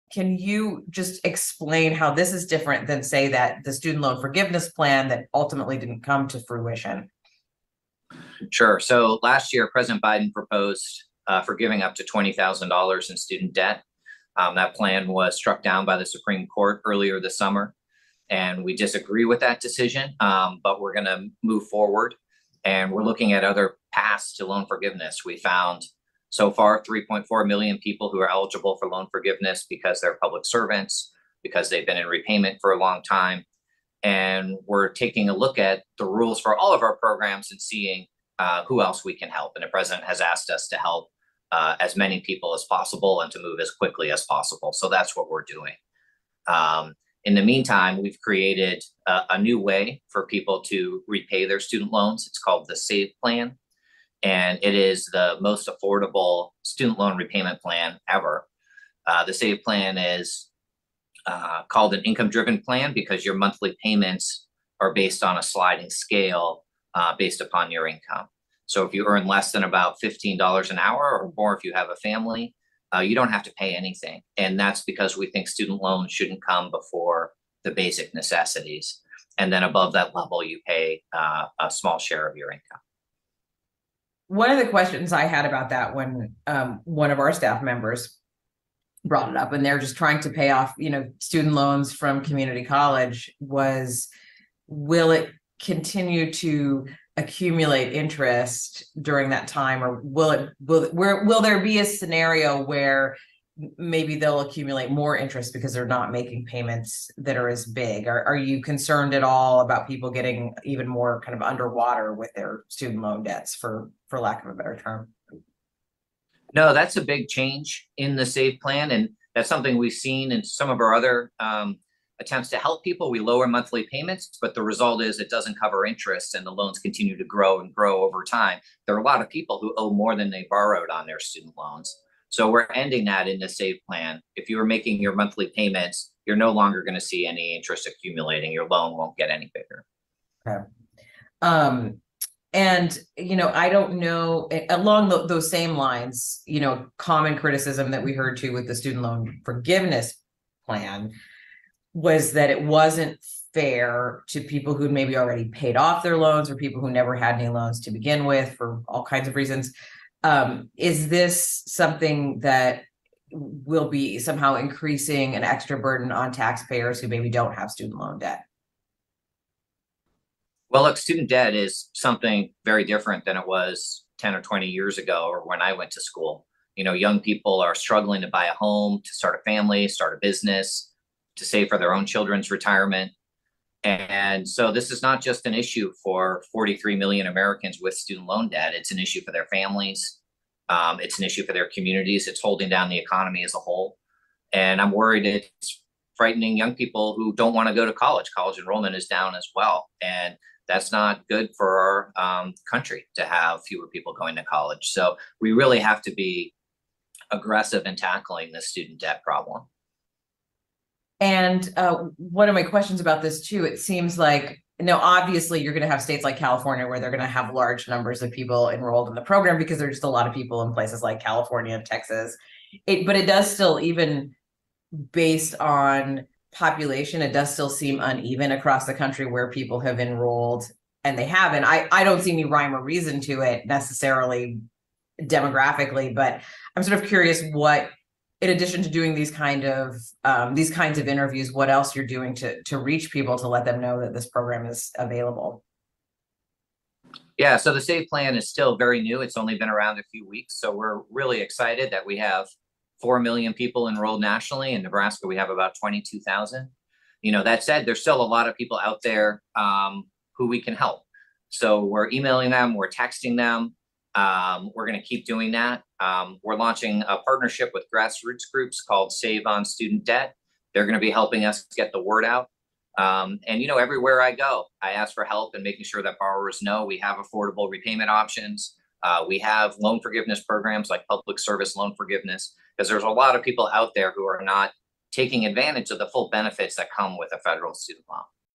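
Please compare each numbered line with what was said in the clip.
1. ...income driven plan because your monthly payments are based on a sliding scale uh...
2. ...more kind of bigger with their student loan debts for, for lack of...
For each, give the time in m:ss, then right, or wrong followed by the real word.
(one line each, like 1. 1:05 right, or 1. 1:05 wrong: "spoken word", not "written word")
1. 1:02 right
2. 1:50 wrong: "underwater", not "bigger".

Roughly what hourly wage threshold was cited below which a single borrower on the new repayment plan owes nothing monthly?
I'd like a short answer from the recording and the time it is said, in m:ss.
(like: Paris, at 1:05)
$15 an hour, at 1:10.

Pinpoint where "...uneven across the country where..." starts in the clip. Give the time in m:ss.
3:47.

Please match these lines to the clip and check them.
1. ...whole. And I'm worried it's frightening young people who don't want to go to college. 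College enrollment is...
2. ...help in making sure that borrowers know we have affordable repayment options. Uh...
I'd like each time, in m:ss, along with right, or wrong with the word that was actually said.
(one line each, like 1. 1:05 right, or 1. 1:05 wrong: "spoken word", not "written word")
1. 3:13 right
2. 4:35 right.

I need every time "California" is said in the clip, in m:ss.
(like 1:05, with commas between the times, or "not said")
3:36, 3:41.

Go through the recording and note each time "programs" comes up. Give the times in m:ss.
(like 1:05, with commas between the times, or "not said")
0:36, 3:39, 4:04, 4:40.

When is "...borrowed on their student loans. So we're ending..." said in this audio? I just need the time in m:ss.
2:10.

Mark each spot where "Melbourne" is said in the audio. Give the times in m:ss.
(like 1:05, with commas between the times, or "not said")
not said.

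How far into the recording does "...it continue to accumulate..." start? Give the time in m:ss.
1:35.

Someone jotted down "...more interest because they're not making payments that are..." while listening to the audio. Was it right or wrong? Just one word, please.
right.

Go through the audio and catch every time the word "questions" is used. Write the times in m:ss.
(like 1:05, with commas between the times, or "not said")
1:24, 3:32.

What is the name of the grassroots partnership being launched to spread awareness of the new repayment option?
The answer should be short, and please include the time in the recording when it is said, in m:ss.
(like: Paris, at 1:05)
Save on Student Debt, at 4:29.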